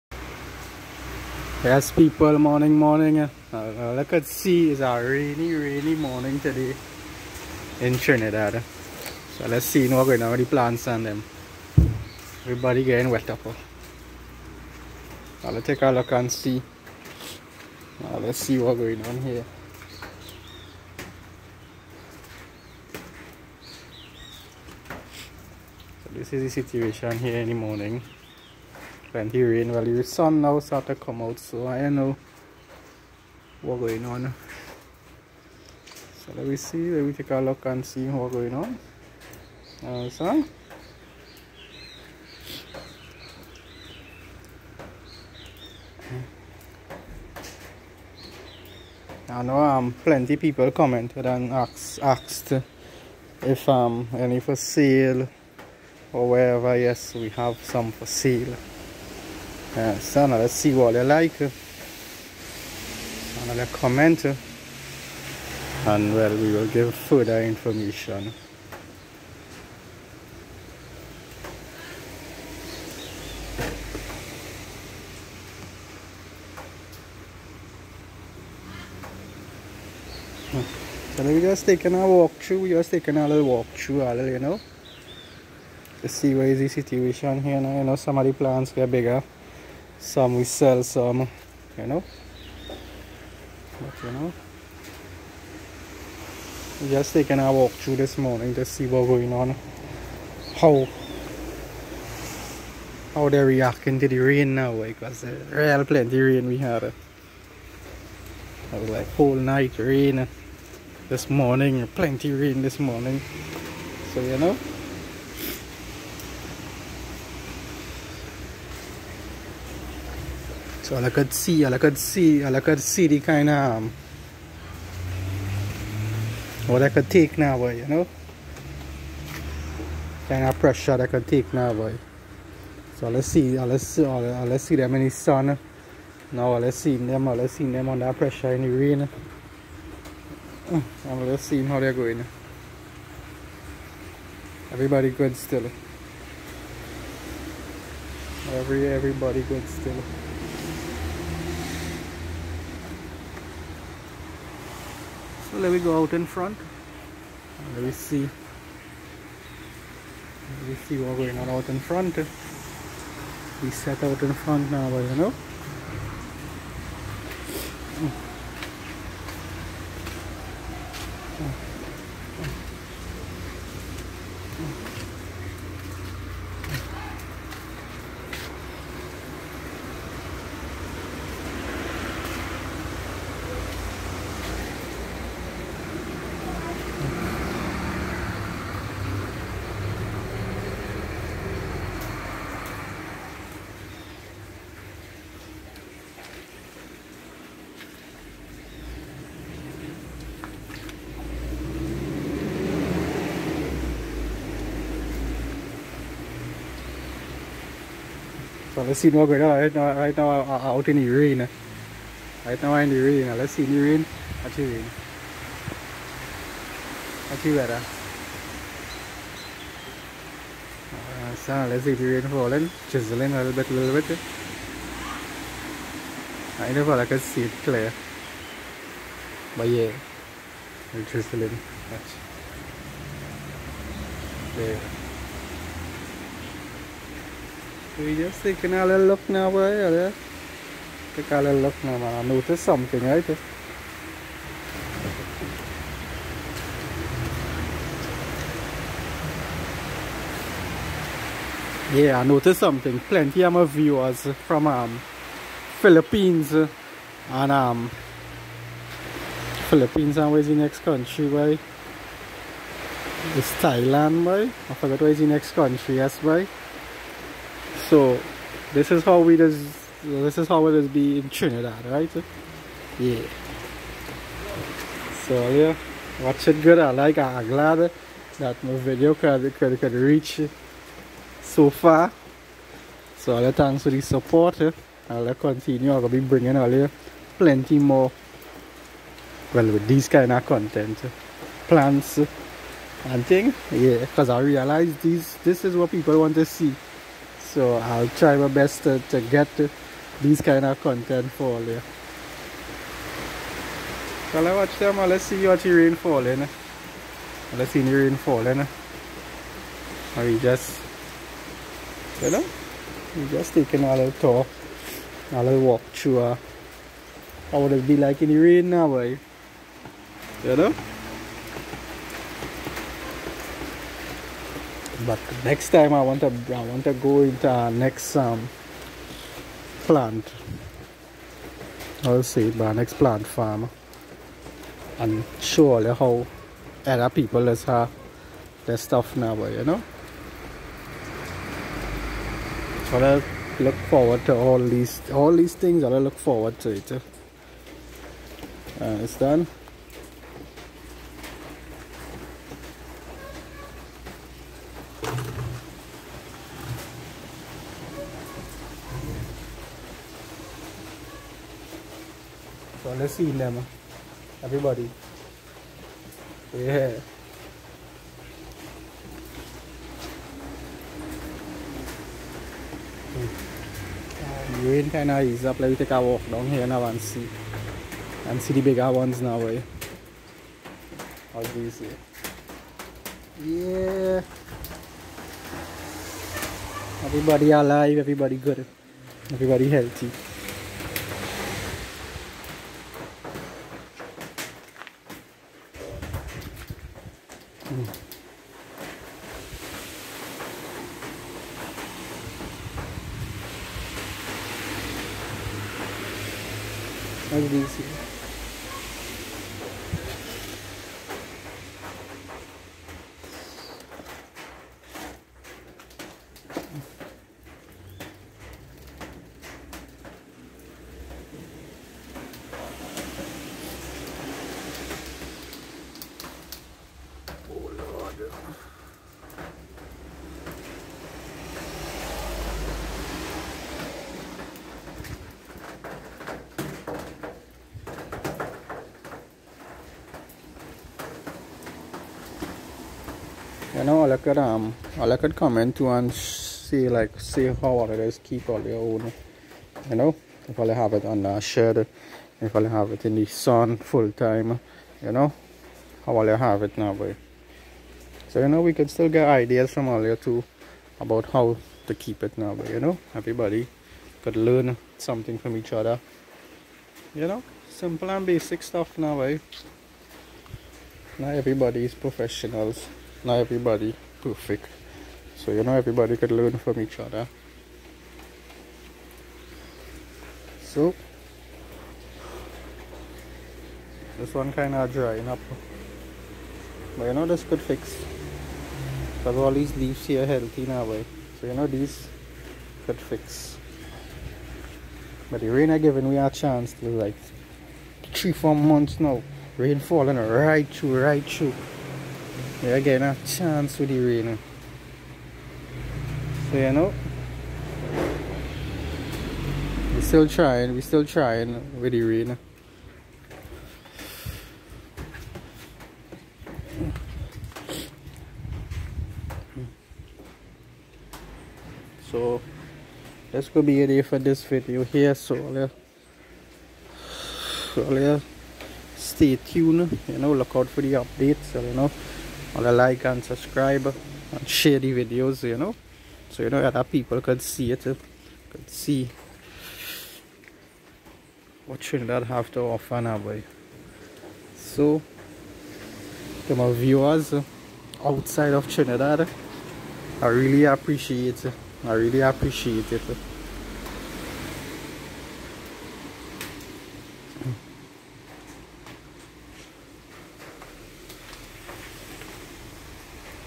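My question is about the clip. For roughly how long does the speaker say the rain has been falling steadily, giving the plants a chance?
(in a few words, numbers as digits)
three four months.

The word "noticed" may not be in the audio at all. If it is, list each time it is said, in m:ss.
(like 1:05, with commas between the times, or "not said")
4:12.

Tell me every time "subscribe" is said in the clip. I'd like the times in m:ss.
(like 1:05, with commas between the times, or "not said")
8:53.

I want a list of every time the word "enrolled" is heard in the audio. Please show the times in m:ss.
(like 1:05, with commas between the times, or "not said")
not said.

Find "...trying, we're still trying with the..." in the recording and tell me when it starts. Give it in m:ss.
8:30.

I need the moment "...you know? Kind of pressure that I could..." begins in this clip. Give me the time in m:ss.
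2:07.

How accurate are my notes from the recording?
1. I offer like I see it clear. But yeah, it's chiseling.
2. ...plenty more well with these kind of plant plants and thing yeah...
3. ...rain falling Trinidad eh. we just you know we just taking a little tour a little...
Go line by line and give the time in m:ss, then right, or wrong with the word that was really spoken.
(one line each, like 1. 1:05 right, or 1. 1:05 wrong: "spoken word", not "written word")
1. 3:46 wrong: "never", not "offer"
2. 4:47 wrong: "content", not "plant"
3. 5:07 wrong: "Are", not "Trinidad".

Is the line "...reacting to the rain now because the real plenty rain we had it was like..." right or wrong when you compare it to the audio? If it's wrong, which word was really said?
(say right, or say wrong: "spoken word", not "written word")
right.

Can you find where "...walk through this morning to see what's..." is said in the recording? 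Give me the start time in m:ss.
1:37.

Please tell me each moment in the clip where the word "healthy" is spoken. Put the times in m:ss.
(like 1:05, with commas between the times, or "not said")
6:29, 8:10.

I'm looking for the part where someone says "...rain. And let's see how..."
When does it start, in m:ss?
2:18.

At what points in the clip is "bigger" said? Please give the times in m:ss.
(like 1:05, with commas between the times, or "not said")
1:28, 6:18.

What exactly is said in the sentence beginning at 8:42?
So, that's gonna be day for this video here.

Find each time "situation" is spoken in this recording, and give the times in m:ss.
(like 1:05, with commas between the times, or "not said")
0:26, 1:26.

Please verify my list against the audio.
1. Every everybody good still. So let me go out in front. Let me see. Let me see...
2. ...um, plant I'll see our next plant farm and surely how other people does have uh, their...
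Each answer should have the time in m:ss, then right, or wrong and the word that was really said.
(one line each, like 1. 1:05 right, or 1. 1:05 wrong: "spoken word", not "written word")
1. 2:28 right
2. 5:28 right.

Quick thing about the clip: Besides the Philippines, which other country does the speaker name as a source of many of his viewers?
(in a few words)
Thailand.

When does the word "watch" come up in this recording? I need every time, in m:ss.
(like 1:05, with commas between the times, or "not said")
3:37, 3:51, 4:36, 5:04.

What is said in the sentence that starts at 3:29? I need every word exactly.
Right now, right now I'm out in the rain.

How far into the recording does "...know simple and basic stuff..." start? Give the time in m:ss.
7:47.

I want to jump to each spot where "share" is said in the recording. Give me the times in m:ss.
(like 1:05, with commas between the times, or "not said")
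8:54.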